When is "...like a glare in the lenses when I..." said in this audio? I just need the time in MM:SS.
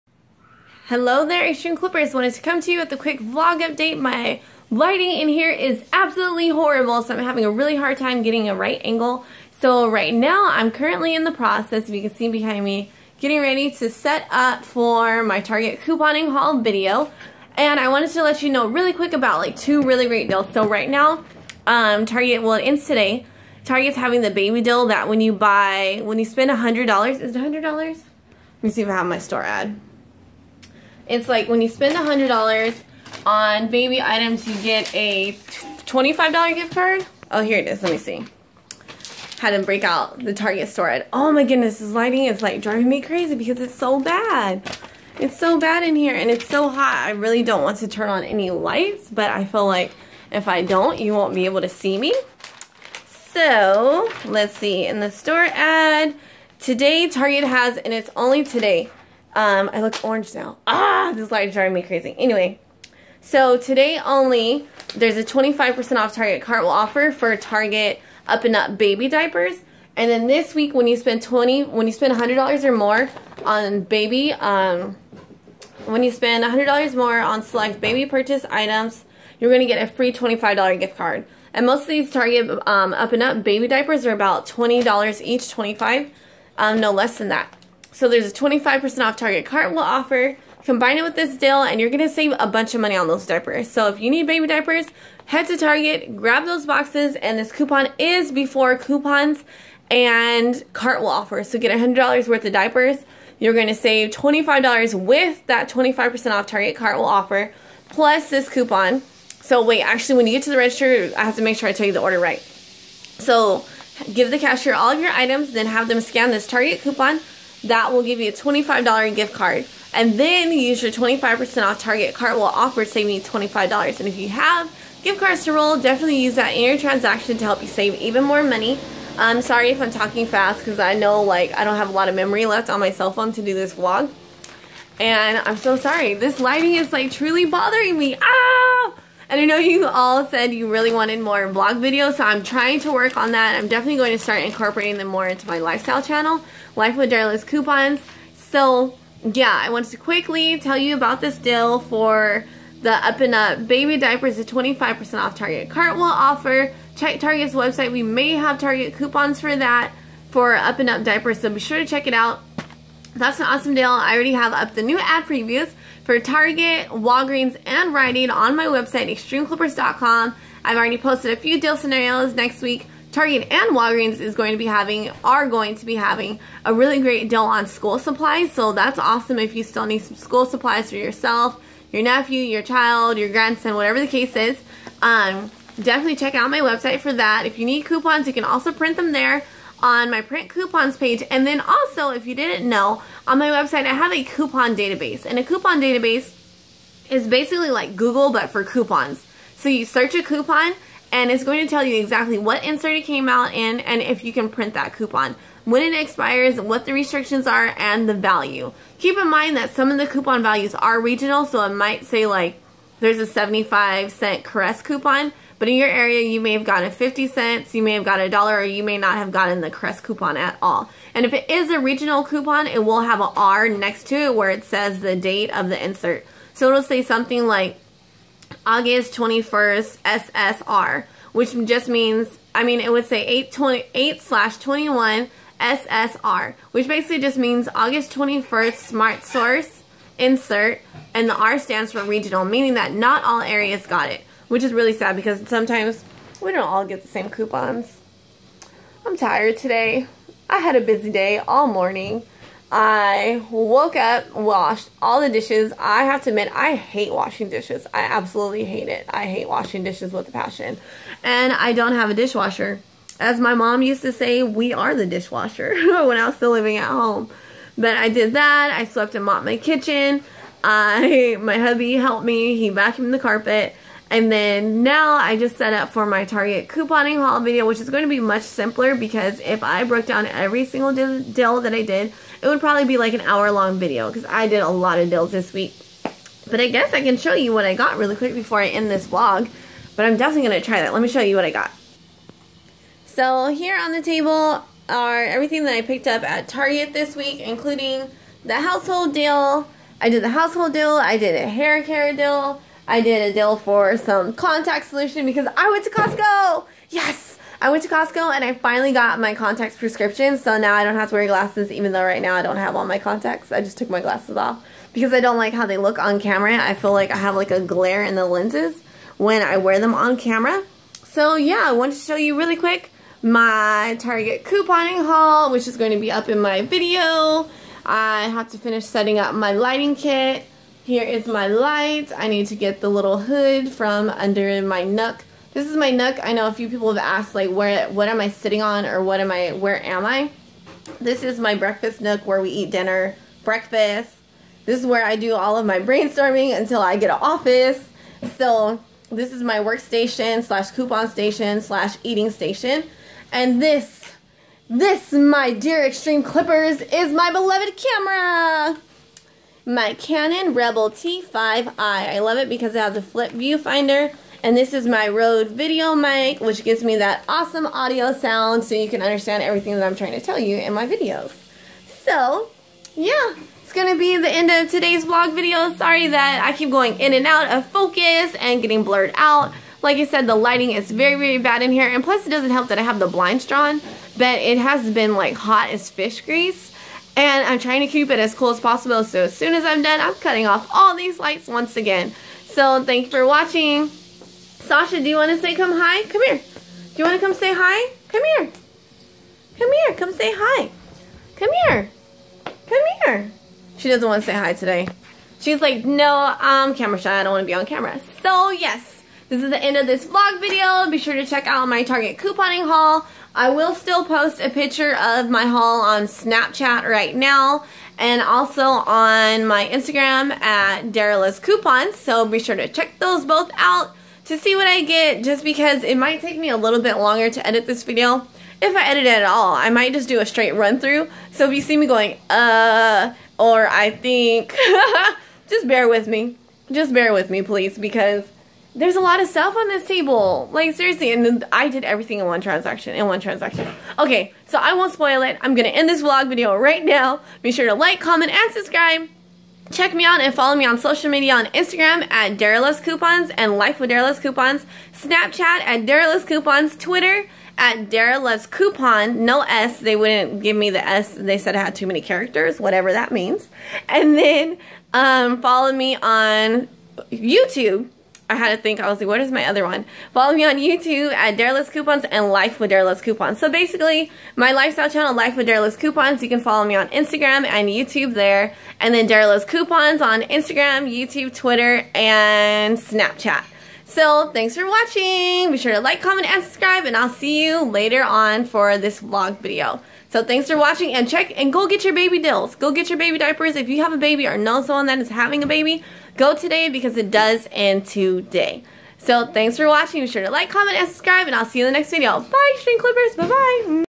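05:17.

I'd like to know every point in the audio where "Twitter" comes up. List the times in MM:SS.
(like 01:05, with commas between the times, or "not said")
07:36, 08:01.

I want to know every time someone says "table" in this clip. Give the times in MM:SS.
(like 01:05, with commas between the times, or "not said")
04:54, 07:19.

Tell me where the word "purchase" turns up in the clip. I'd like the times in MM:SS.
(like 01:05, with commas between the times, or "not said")
01:18.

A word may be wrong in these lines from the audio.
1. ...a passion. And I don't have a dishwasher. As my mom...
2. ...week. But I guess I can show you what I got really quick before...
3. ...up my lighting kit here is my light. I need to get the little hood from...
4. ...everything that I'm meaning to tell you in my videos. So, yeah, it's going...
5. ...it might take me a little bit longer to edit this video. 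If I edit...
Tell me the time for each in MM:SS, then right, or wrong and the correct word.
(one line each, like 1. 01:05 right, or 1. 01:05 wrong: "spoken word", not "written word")
1. 04:20 right
2. 04:45 right
3. 05:29 right
4. 06:09 wrong: "trying", not "meaning"
5. 07:05 right.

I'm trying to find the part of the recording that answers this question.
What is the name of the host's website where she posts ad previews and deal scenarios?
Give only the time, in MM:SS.
02:49.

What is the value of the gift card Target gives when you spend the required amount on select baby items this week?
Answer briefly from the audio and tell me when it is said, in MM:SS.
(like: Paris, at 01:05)
$25, at 00:34.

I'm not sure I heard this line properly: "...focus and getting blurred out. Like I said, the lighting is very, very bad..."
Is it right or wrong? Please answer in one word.
right.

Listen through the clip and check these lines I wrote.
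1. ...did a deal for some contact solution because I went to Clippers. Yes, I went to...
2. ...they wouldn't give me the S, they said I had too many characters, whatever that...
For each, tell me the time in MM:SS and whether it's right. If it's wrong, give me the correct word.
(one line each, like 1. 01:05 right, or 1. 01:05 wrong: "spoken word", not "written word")
1. 05:02 wrong: "Costco", not "Clippers"
2. 07:39 right.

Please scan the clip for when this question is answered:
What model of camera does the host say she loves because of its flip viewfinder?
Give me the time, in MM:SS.
05:59.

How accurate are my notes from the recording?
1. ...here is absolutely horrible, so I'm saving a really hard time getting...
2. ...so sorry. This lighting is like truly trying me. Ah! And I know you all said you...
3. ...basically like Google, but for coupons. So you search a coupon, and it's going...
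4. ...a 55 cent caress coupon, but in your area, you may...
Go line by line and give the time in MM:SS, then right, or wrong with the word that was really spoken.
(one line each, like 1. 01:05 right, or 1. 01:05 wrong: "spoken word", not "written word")
1. 00:05 wrong: "having", not "saving"
2. 02:15 wrong: "bothering", not "trying"
3. 03:17 right
4. 03:33 wrong: "75", not "55".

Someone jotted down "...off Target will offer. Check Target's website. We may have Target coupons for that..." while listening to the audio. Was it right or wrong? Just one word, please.
right.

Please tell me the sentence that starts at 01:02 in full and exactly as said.
Anyway, so today only, there's a 25% off Target Cartwheel offer for Target Up and Up baby diapers.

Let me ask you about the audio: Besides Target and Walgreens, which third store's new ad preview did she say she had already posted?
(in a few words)
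Rite Aid.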